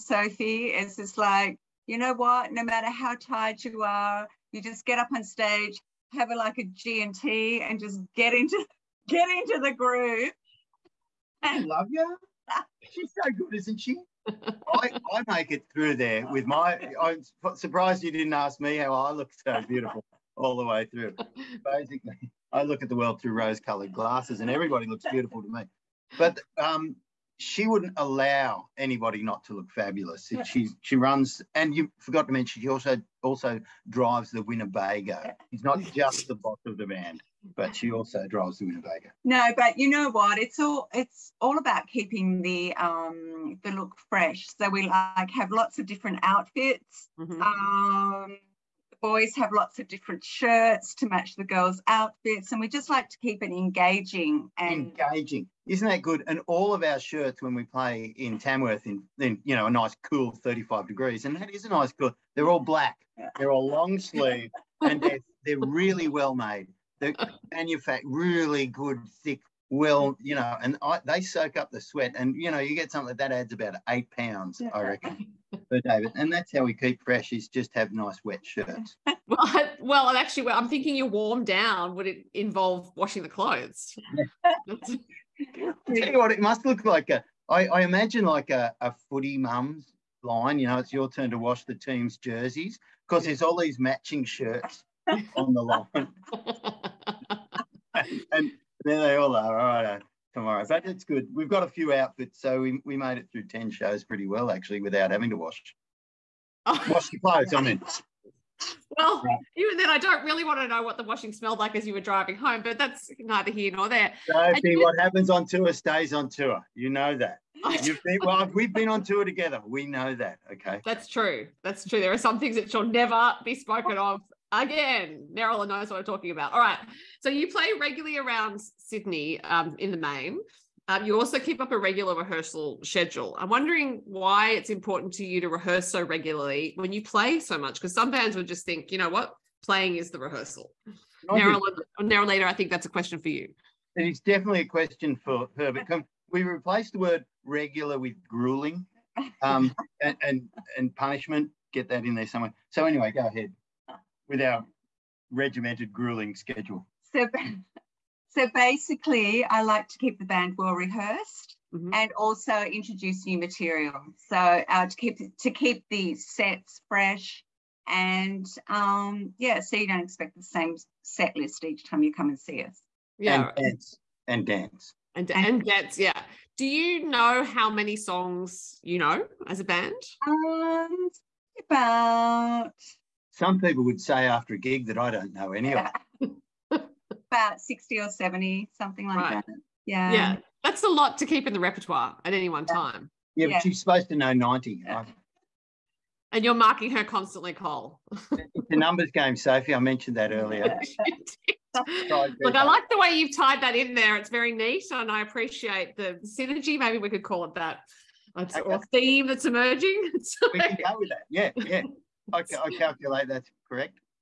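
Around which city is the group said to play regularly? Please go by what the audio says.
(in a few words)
Sydney.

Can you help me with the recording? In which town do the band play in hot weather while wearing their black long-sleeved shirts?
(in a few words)
Tamworth.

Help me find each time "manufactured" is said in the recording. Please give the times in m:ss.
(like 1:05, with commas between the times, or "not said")
1:07.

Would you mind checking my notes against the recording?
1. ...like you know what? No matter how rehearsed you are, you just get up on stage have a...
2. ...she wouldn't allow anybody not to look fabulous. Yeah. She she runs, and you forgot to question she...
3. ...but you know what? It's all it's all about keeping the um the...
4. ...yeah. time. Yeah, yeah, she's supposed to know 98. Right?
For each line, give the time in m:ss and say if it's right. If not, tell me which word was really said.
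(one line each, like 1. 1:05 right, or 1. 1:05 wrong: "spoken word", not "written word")
1. 0:01 wrong: "tired", not "rehearsed"
2. 0:27 wrong: "mention", not "question"
3. 0:39 right
4. 3:12 wrong: "90", not "98".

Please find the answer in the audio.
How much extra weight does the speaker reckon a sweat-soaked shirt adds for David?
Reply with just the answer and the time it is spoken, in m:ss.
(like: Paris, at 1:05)
8 pounds, at 1:13.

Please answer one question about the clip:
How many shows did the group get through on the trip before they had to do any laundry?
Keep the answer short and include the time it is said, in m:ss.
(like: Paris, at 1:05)
10, at 1:43.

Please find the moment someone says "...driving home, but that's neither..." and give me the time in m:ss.
1:52.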